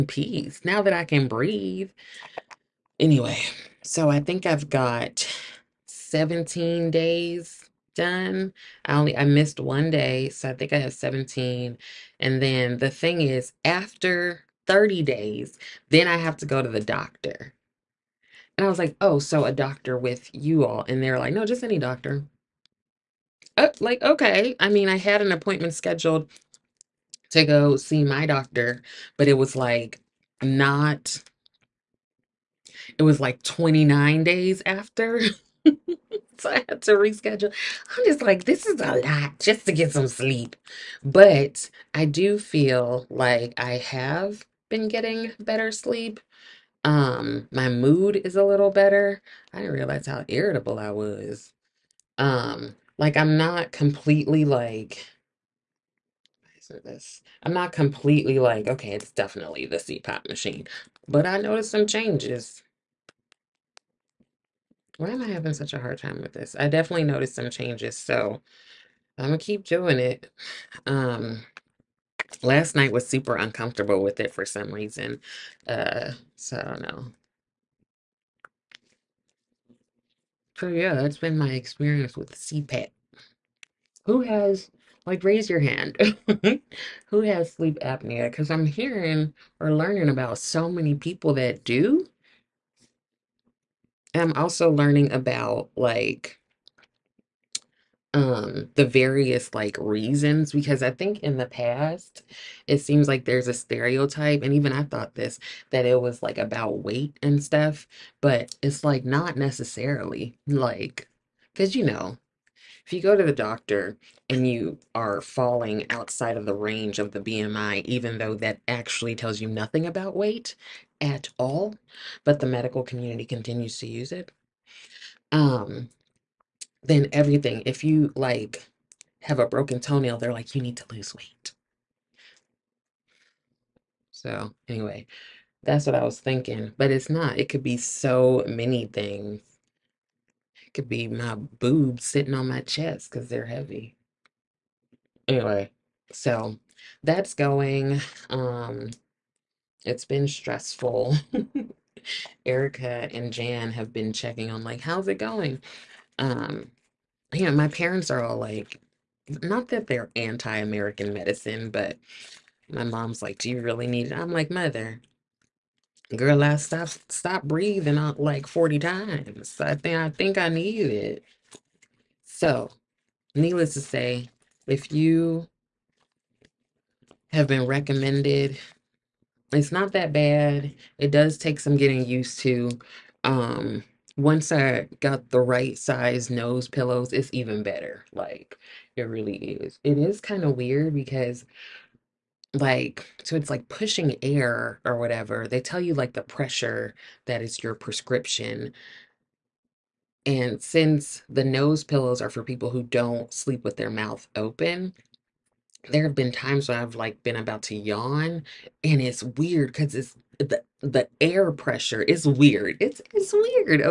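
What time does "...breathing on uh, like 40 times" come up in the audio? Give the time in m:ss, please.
2:47.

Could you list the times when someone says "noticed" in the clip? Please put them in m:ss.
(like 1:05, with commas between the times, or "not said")
1:01, 1:07.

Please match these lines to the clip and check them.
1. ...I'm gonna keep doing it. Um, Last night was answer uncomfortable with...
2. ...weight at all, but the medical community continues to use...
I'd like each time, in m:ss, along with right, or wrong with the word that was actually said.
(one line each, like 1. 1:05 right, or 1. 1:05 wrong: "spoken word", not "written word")
1. 1:09 wrong: "super", not "answer"
2. 2:00 right.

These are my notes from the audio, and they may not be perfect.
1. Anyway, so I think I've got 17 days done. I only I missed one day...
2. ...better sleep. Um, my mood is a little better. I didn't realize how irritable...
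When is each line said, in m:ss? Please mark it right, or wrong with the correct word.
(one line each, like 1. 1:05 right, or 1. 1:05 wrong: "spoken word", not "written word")
1. 0:02 right
2. 0:45 right.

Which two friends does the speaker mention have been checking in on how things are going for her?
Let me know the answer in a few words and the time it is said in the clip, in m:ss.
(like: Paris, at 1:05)
Erica and Jan, at 2:32.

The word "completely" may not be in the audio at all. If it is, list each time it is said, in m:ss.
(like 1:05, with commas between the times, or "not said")
0:53, 0:57.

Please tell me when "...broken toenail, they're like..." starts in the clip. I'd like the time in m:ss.
2:09.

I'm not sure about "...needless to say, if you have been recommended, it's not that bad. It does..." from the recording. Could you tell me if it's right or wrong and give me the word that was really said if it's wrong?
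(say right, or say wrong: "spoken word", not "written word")
right.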